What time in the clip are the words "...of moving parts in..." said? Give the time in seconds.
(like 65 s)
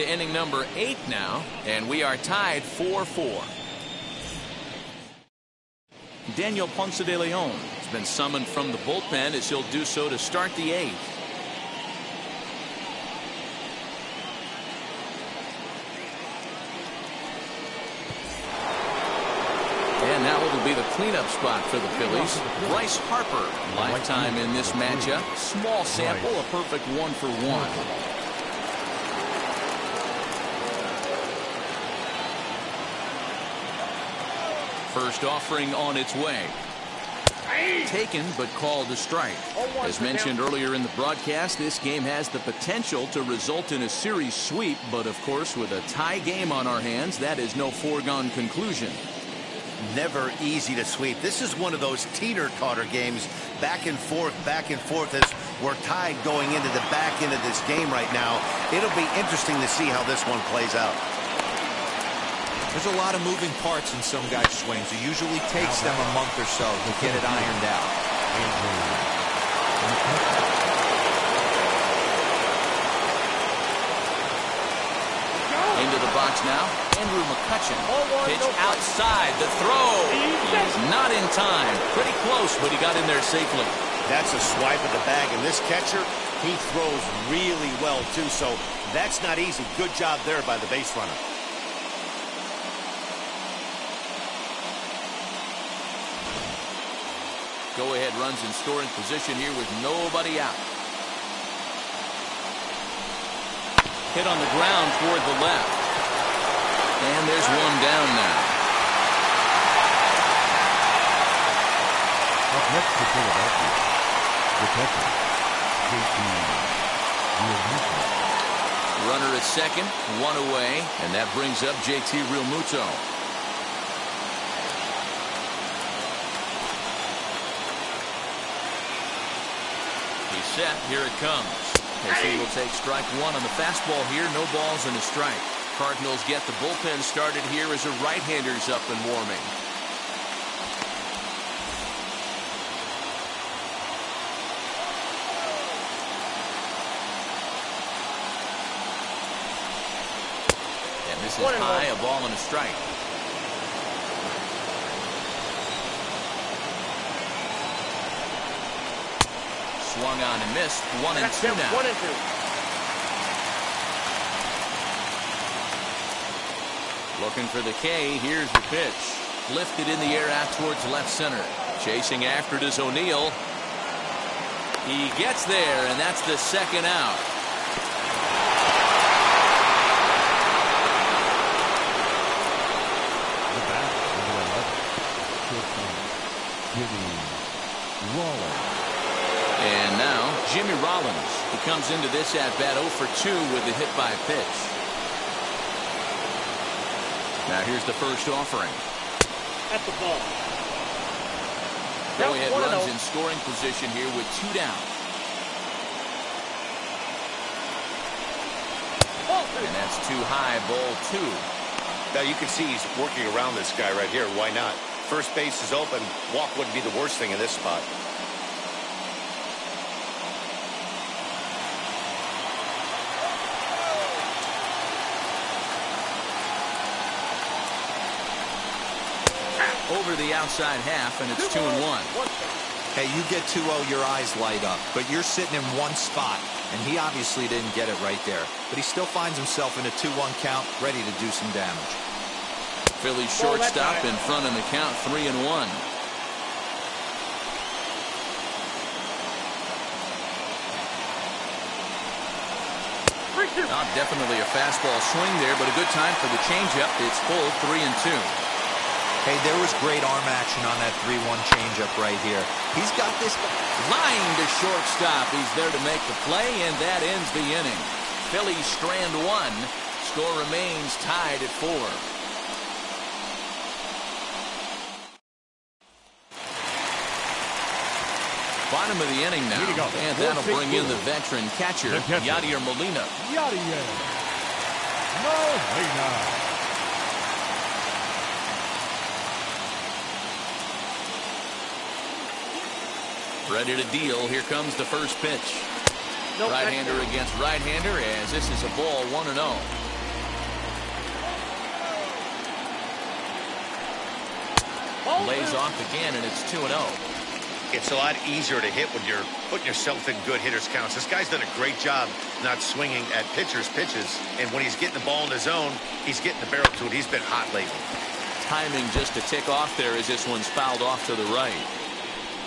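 63 s.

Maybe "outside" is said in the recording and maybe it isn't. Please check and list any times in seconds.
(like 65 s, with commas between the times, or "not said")
78 s, 230 s.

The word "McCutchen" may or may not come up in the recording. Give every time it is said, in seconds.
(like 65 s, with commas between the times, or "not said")
77 s.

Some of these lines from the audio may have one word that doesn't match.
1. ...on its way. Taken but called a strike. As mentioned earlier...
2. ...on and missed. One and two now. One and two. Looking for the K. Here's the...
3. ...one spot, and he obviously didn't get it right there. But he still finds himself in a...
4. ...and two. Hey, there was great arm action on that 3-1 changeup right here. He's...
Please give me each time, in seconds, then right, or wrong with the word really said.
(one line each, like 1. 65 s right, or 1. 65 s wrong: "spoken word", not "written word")
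1. 35 s right
2. 160 s right
3. 235 s right
4. 257 s right.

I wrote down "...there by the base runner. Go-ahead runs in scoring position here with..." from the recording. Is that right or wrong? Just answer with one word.
right.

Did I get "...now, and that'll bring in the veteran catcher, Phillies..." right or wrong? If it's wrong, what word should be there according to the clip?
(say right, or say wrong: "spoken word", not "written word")
wrong: "Yadier", not "Phillies".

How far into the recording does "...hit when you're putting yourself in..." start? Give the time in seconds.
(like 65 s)
308 s.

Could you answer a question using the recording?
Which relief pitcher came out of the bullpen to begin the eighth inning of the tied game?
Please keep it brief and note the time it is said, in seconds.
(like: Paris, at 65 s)
Daniel Ponce de Leon, at 6 s.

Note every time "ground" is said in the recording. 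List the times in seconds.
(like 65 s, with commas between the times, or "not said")
104 s.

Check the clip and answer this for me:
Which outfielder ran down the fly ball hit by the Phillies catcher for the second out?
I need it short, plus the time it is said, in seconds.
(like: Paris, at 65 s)
O'Neill, at 172 s.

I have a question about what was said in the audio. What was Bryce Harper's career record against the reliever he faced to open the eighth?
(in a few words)
1 for 1.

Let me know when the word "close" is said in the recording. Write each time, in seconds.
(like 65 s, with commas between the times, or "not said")
82 s.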